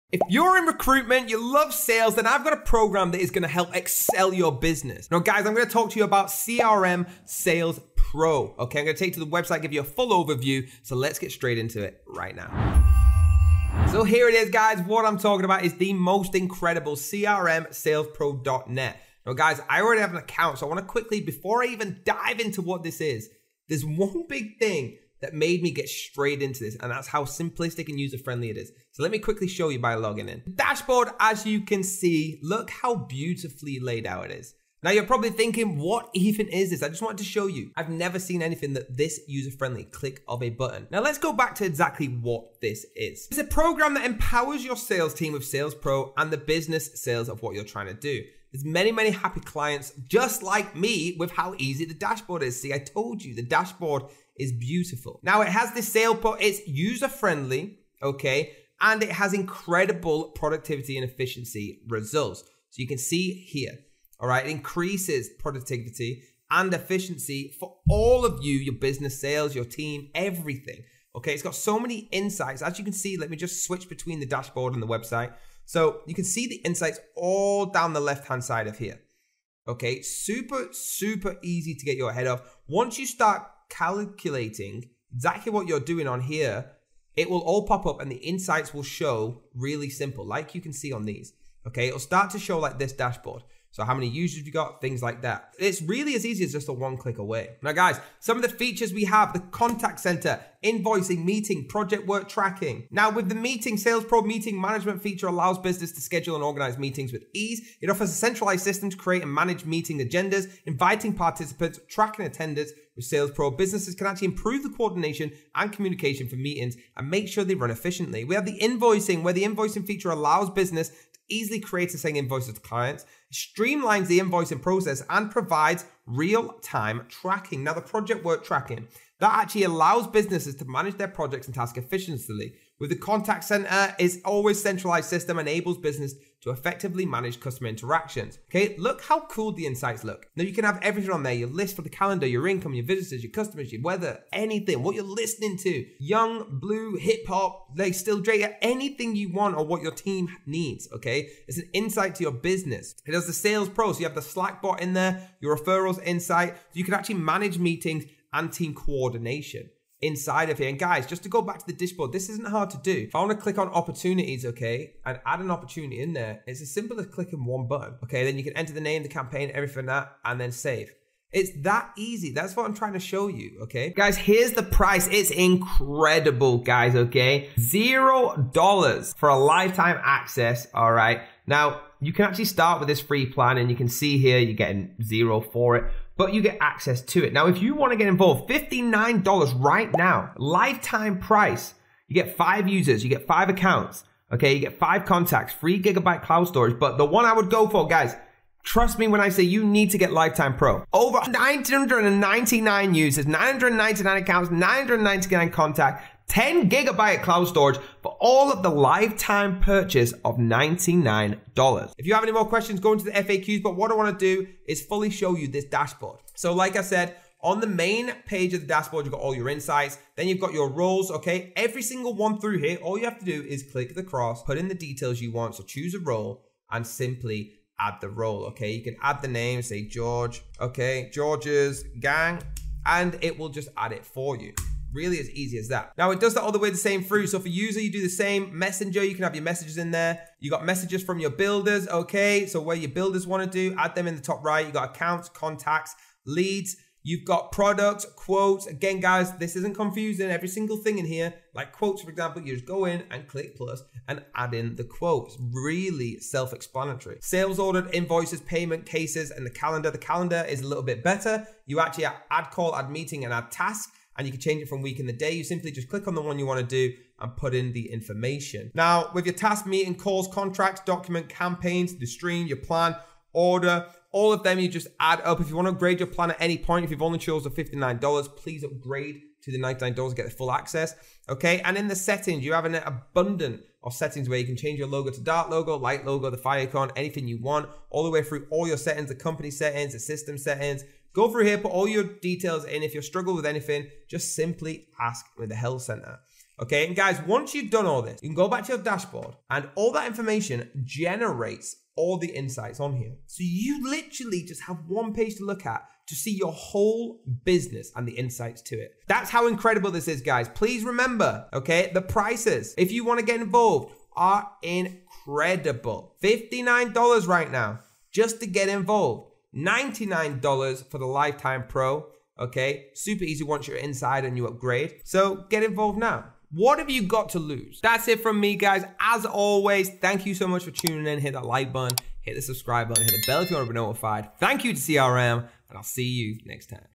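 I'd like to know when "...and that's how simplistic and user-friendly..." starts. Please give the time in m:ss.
0:26.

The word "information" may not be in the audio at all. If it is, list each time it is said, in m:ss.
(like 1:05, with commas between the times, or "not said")
4:27, 5:00.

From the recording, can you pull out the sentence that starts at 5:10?
Please remember, okay, the prices, if you want to get involved, are incredible.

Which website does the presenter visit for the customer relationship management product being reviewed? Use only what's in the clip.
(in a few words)
salespro.net.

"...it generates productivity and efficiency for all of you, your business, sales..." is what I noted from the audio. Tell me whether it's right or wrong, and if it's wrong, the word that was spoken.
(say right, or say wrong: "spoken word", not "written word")
wrong: "increases", not "generates".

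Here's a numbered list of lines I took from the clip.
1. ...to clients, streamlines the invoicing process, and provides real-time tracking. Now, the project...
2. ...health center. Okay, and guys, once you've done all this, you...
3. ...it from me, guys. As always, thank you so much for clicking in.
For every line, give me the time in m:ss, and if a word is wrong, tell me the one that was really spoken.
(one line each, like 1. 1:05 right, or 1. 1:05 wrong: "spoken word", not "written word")
1. 2:02 right
2. 4:55 right
3. 5:28 wrong: "tuning", not "clicking".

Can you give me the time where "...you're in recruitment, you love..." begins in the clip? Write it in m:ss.
0:00.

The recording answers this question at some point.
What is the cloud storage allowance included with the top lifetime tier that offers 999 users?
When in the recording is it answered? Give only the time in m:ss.
3:26.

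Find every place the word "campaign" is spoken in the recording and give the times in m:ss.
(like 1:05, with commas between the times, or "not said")
2:49, 4:31.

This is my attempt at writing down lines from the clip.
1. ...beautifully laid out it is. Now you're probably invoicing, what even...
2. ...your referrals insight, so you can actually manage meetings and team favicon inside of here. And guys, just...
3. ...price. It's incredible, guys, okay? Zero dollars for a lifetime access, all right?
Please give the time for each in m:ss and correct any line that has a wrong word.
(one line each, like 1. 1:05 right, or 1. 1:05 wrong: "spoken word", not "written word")
1. 0:32 wrong: "thinking", not "invoicing"
2. 2:35 wrong: "coordination", not "favicon"
3. 2:54 right.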